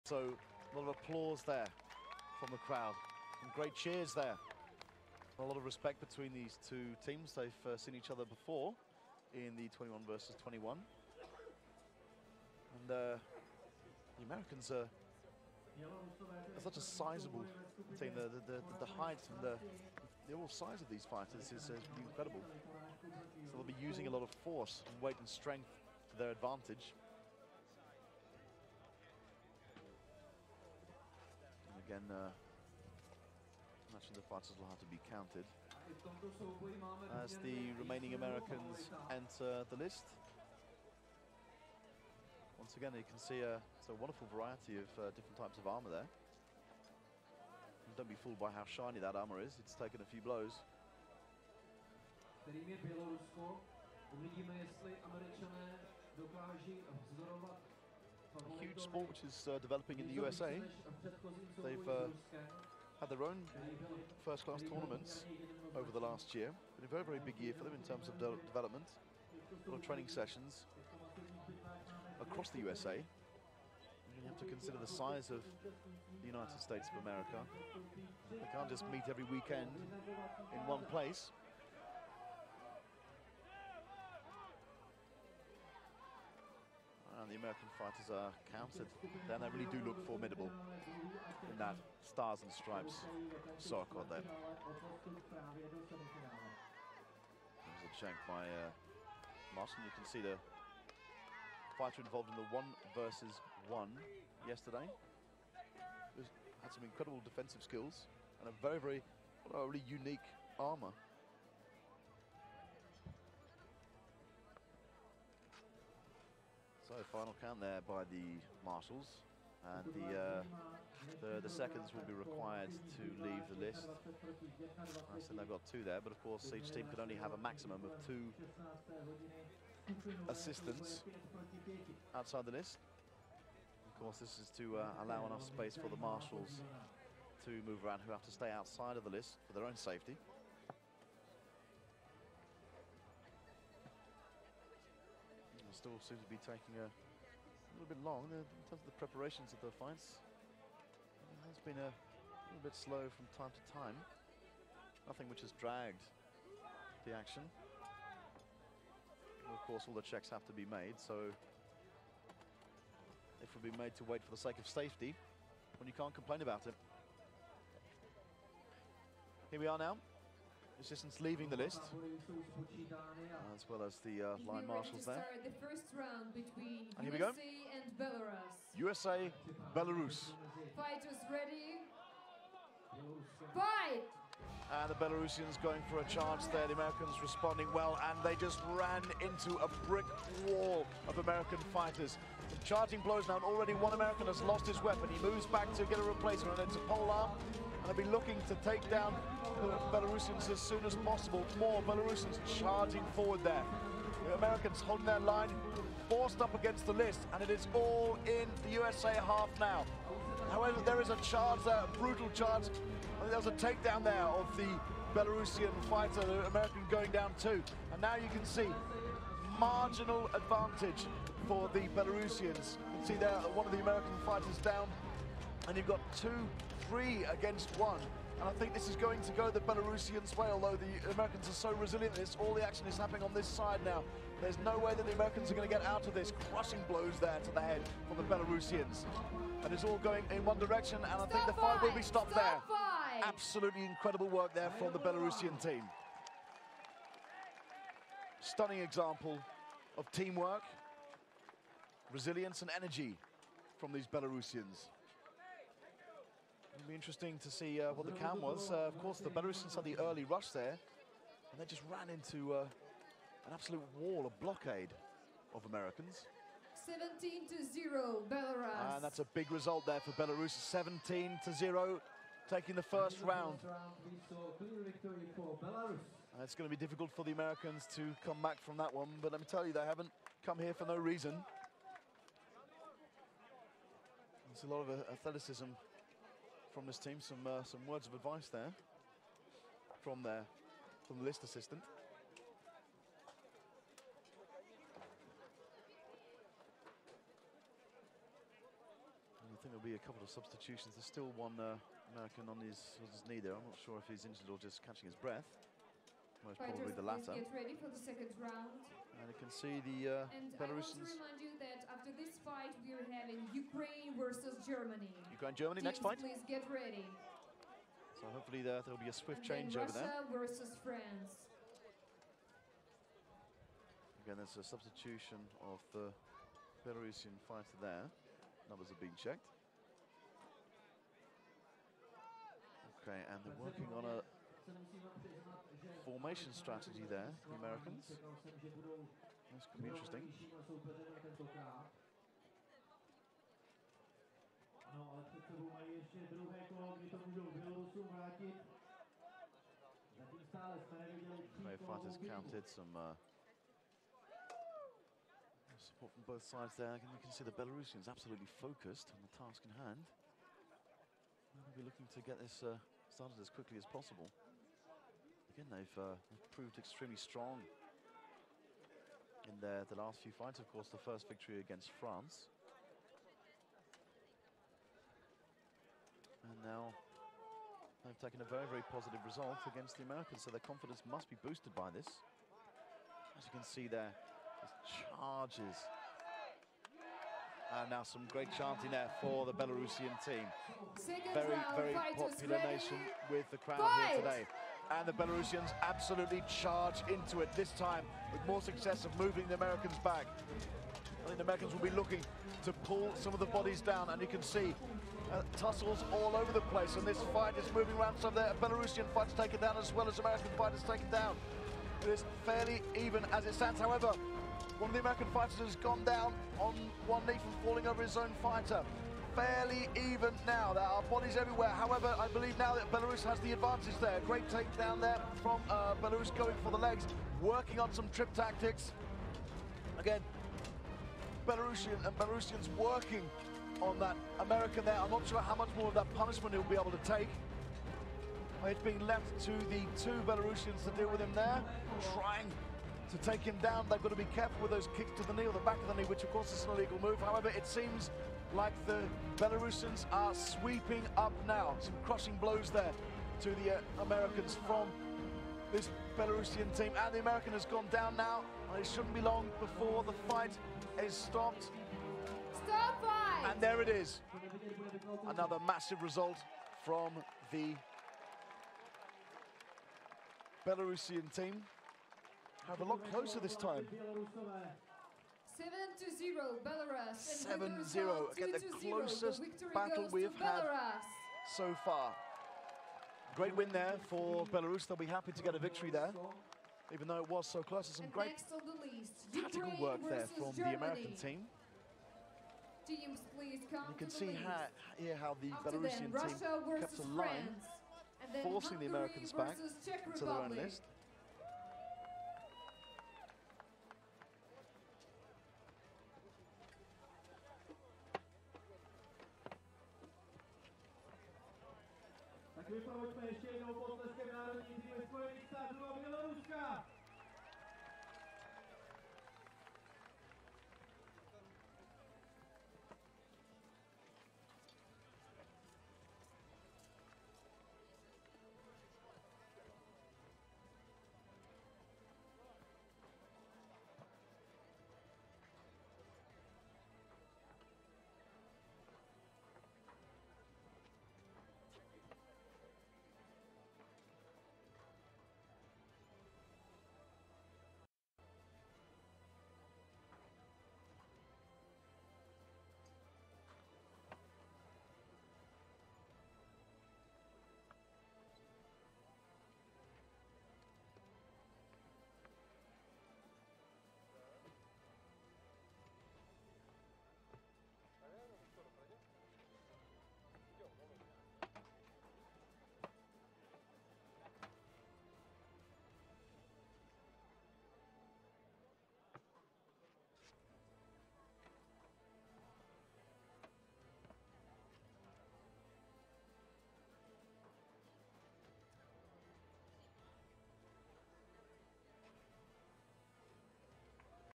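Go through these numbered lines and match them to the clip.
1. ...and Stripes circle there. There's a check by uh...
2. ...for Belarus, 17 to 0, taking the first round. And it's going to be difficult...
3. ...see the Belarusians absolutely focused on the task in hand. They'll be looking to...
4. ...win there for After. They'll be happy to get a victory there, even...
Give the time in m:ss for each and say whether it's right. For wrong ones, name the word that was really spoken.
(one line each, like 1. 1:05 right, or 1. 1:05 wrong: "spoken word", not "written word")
1. 1:32 right
2. 4:29 right
3. 5:57 right
4. 8:03 wrong: "Belarus", not "After".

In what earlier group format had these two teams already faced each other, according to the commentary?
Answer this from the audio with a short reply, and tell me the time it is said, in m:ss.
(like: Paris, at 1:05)
21 versus 21, at 0:09.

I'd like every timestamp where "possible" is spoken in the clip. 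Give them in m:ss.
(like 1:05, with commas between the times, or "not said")
3:20, 6:03.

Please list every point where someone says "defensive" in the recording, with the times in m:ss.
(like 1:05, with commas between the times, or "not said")
1:47.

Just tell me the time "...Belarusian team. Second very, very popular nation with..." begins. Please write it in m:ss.
6:29.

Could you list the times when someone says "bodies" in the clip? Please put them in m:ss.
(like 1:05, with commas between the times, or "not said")
6:43, 7:01.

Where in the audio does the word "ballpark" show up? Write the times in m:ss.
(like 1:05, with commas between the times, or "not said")
not said.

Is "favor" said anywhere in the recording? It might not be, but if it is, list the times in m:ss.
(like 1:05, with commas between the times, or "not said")
not said.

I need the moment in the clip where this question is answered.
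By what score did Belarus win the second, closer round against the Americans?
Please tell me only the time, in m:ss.
7:55.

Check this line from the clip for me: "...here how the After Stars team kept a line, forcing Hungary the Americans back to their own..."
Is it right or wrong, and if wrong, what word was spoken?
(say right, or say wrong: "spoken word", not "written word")
wrong: "Belarusian", not "Stars".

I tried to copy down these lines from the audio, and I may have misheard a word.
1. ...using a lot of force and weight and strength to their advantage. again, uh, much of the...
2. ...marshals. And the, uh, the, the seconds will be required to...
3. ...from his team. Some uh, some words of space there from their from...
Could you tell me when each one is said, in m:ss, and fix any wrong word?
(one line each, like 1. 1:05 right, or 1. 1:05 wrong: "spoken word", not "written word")
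1. 0:23 right
2. 1:58 right
3. 4:46 wrong: "advice", not "space".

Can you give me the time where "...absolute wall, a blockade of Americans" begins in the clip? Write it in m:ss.
4:23.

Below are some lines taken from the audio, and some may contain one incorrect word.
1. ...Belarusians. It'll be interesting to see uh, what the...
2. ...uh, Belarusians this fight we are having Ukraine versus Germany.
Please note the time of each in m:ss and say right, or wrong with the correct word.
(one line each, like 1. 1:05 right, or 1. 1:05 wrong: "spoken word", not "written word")
1. 4:14 right
2. 5:10 right.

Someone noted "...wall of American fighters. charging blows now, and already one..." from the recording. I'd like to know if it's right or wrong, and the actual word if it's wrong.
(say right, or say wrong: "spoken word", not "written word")
right.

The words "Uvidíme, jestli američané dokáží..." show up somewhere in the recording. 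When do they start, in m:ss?
0:54.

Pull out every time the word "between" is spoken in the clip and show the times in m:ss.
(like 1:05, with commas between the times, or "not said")
0:06, 2:56.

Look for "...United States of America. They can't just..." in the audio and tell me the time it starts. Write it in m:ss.
1:16.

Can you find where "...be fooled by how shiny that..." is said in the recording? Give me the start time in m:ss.
0:48.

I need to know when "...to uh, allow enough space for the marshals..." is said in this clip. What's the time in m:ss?
2:14.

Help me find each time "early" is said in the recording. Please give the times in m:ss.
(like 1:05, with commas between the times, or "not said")
4:19.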